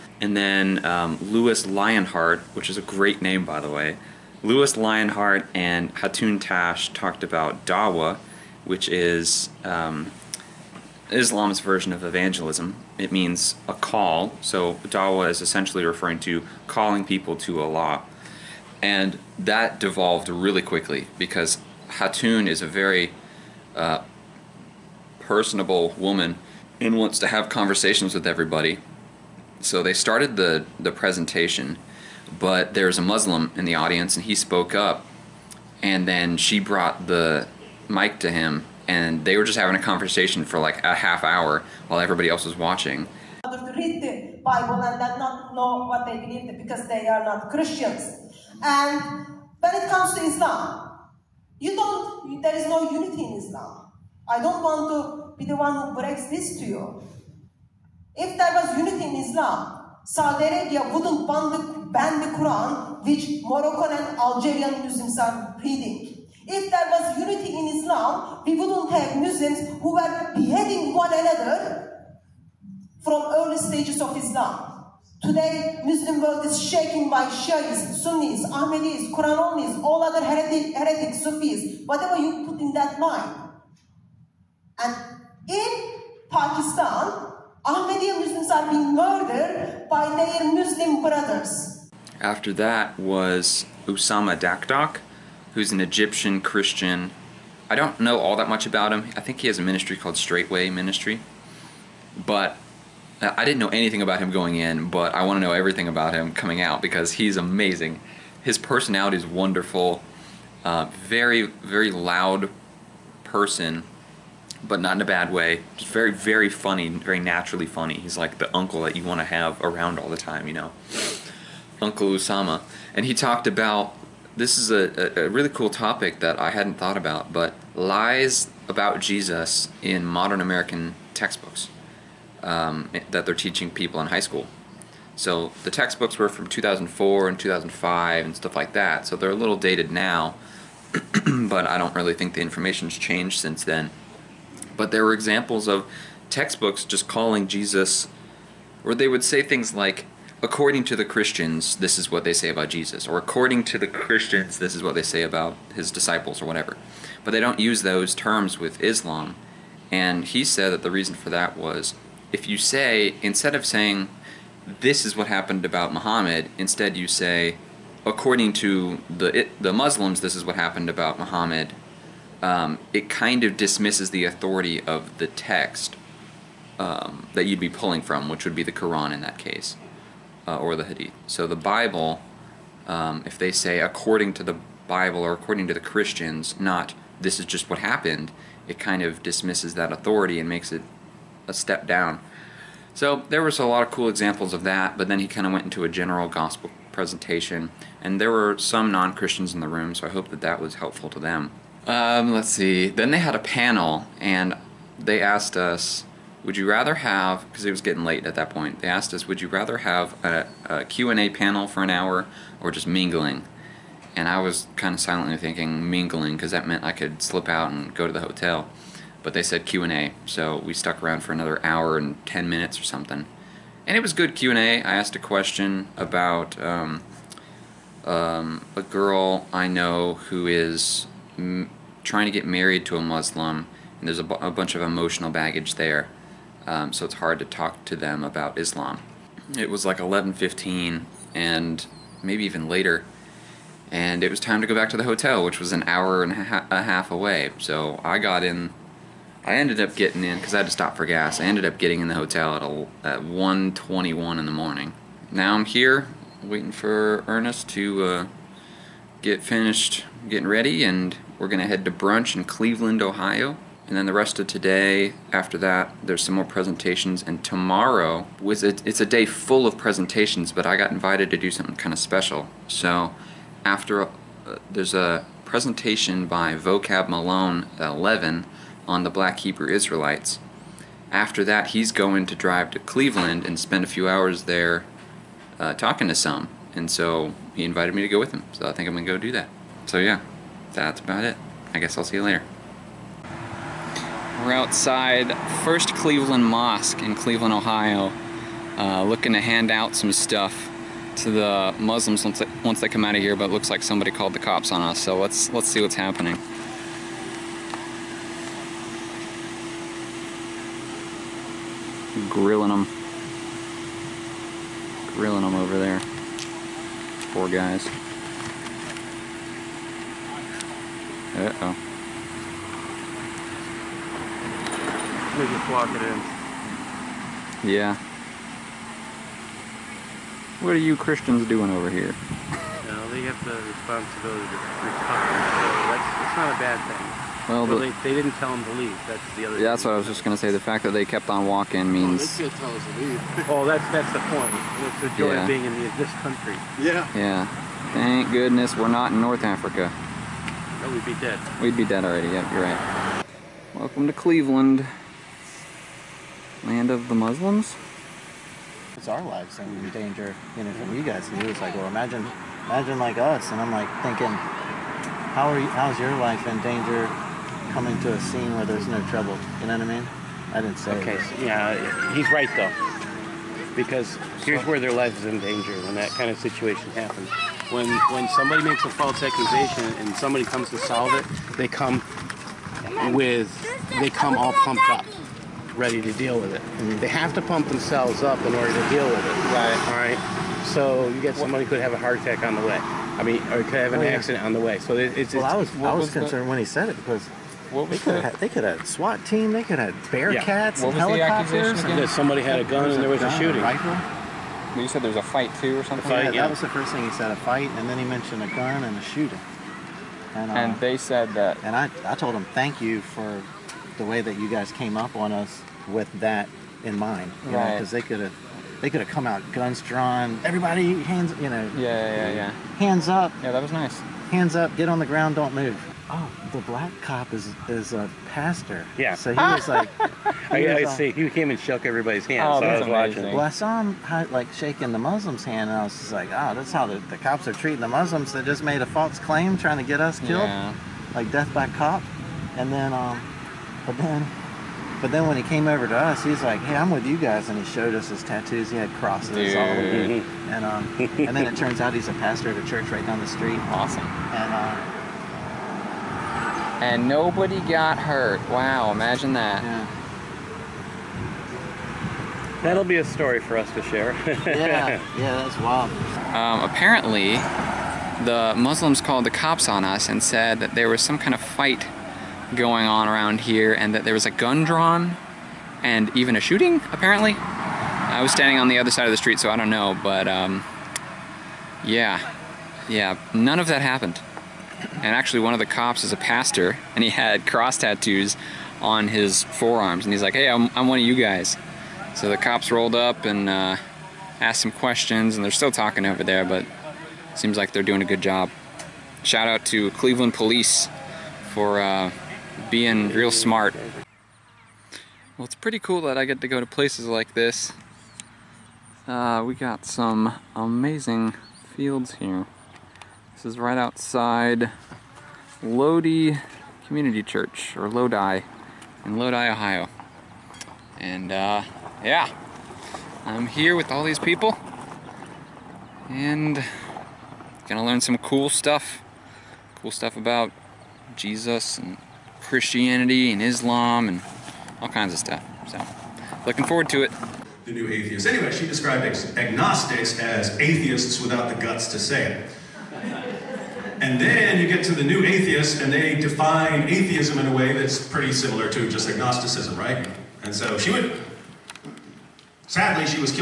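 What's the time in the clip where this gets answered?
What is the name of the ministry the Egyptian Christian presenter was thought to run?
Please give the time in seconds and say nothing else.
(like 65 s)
100 s.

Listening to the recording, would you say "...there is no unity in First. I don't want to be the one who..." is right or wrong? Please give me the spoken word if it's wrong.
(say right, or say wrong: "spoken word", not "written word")
wrong: "Islam", not "First".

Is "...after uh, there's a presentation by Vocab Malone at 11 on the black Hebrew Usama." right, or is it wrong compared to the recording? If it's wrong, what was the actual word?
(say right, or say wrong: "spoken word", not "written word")
wrong: "Israelites", not "Usama".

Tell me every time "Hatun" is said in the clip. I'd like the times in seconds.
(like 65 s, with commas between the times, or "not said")
5 s, 21 s.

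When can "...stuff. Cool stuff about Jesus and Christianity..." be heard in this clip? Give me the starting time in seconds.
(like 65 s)
528 s.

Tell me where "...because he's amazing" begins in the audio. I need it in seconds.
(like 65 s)
106 s.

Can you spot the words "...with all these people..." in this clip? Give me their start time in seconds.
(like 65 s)
523 s.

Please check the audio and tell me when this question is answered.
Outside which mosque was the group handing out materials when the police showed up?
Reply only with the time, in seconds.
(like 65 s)
295 s.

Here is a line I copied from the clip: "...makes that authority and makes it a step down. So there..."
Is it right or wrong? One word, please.
wrong.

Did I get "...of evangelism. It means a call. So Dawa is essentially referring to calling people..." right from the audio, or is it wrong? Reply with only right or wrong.
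right.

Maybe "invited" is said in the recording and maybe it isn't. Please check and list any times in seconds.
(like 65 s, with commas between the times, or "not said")
270 s, 287 s.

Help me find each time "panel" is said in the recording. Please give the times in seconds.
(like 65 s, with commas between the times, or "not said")
203 s, 211 s.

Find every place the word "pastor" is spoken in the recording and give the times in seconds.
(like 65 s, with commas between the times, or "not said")
428 s, 452 s, 486 s.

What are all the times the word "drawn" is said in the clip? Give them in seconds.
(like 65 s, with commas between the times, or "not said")
419 s, 474 s.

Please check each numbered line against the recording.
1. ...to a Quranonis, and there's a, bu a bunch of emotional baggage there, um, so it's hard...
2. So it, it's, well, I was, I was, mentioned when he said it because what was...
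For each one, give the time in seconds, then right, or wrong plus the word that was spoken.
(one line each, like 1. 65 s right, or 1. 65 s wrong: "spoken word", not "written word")
1. 232 s wrong: "Muslim", not "Quranonis"
2. 394 s wrong: "concerned", not "mentioned".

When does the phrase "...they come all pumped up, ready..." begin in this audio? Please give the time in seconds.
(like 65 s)
383 s.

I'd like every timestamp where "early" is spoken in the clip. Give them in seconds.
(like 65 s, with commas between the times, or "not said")
73 s.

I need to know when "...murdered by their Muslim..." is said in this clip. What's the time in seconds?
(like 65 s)
88 s.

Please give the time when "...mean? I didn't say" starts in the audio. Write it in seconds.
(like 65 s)
369 s.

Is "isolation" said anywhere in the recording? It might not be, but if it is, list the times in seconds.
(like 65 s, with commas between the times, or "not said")
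not said.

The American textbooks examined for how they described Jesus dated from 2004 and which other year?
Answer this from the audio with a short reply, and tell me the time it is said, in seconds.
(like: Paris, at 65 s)
2005, at 137 s.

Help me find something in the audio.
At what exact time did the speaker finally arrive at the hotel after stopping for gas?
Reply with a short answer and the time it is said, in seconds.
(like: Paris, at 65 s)
1:21, at 253 s.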